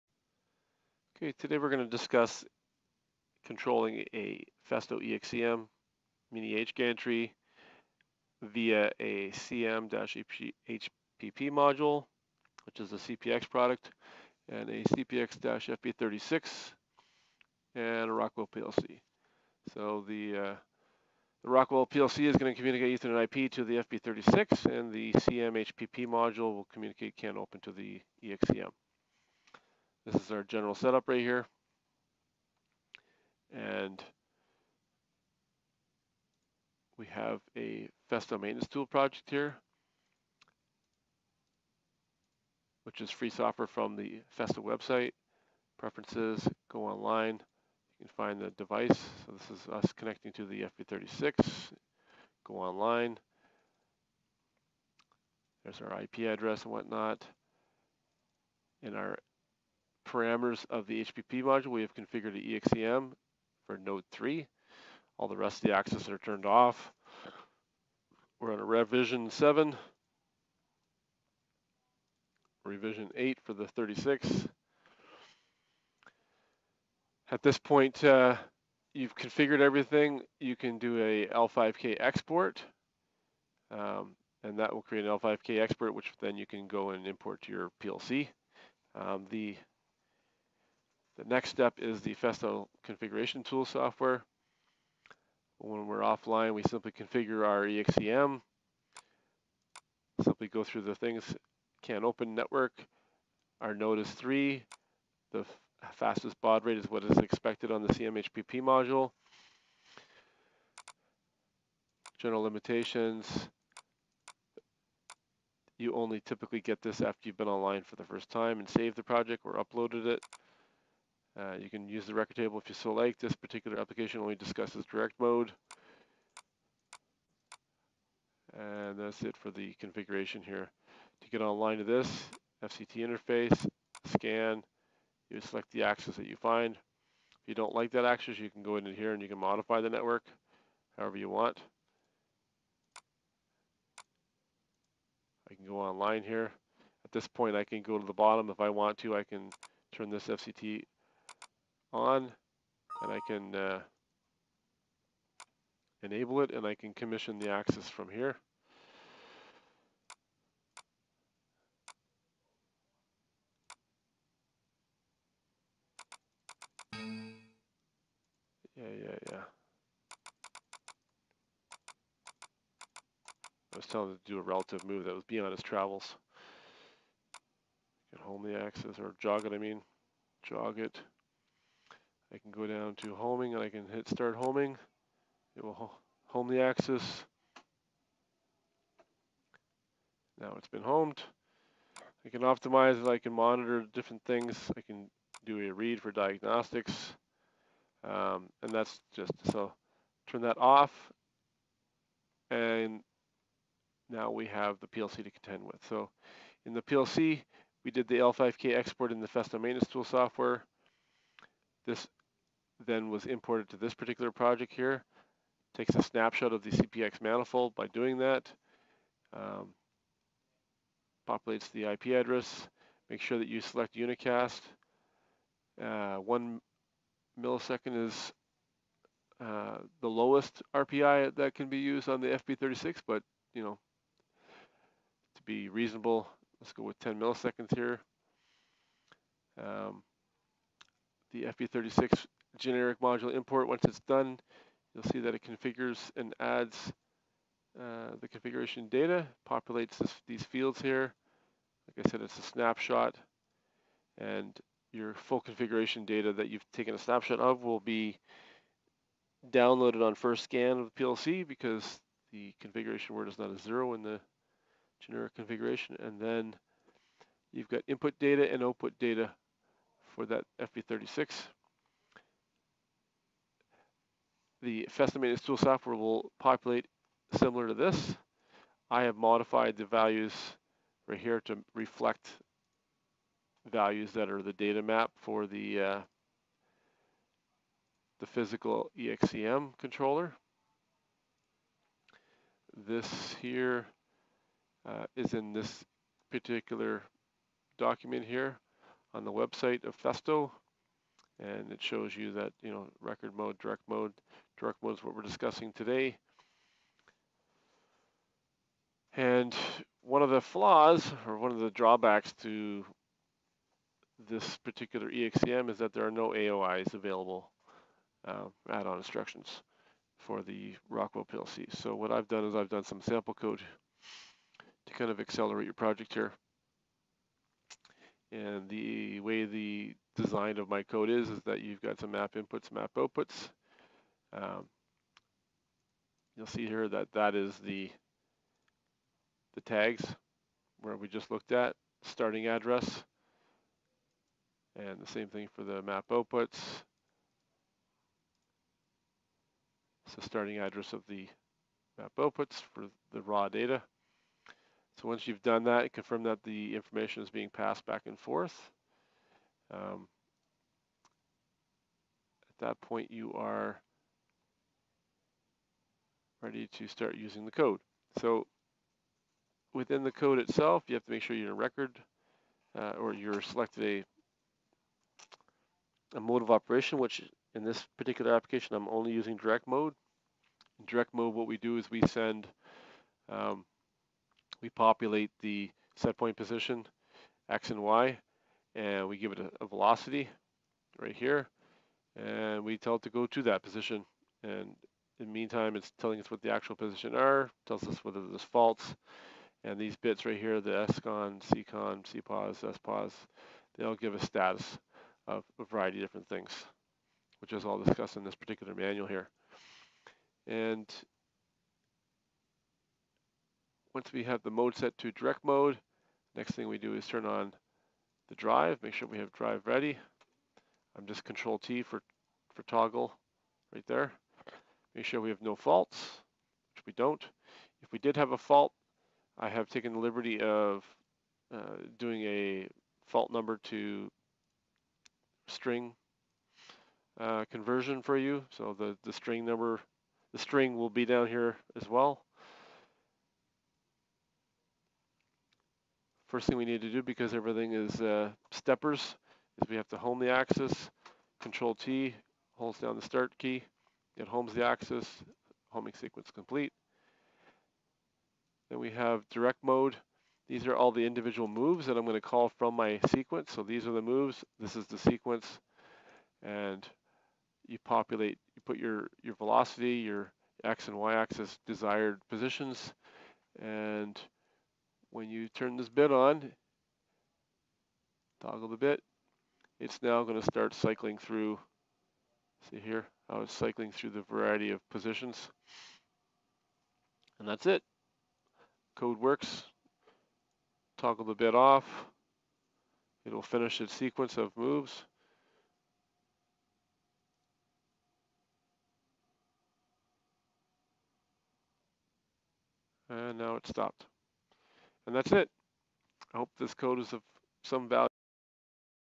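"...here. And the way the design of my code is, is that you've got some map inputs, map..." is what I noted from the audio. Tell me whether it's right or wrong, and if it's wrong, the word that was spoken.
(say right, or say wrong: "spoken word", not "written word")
right.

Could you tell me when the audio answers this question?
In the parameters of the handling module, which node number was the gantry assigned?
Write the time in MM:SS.
01:03.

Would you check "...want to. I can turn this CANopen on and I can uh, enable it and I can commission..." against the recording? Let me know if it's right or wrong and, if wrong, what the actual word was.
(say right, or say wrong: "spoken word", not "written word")
wrong: "FCT", not "CANopen".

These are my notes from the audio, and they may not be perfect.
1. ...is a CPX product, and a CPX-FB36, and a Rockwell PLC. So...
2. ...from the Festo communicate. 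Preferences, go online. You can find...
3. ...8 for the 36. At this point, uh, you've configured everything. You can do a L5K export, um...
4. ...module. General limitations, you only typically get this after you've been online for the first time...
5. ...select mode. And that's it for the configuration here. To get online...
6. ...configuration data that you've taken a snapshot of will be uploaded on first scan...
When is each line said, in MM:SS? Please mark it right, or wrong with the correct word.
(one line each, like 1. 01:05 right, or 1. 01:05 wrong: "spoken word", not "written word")
1. 00:12 right
2. 00:43 wrong: "website", not "communicate"
3. 01:13 right
4. 01:48 right
5. 02:04 wrong: "direct", not "select"
6. 04:15 wrong: "downloaded", not "uploaded".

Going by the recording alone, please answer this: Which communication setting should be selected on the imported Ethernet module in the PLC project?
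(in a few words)
Unicast.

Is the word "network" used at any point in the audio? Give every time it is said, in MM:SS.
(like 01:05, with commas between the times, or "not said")
01:42, 02:19.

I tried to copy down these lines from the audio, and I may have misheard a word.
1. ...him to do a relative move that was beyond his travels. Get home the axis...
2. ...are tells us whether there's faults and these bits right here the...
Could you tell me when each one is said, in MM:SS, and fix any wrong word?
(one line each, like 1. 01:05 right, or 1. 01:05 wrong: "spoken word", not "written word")
1. 02:54 right
2. 06:37 right.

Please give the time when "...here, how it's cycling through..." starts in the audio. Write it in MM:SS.
08:02.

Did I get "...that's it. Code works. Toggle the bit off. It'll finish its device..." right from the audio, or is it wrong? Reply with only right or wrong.
wrong.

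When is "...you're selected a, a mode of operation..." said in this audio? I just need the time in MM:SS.
06:13.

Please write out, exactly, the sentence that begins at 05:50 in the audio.
So starting address of the map outputs for the raw data.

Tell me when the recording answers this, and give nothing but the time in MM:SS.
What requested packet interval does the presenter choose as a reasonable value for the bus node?
03:56.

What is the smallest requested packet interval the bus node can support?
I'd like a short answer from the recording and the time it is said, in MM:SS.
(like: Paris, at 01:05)
1 millisecond, at 03:46.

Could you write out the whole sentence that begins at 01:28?
Um, the the next step is the Festo configuration tool software.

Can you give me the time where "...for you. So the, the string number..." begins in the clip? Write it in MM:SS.
07:18.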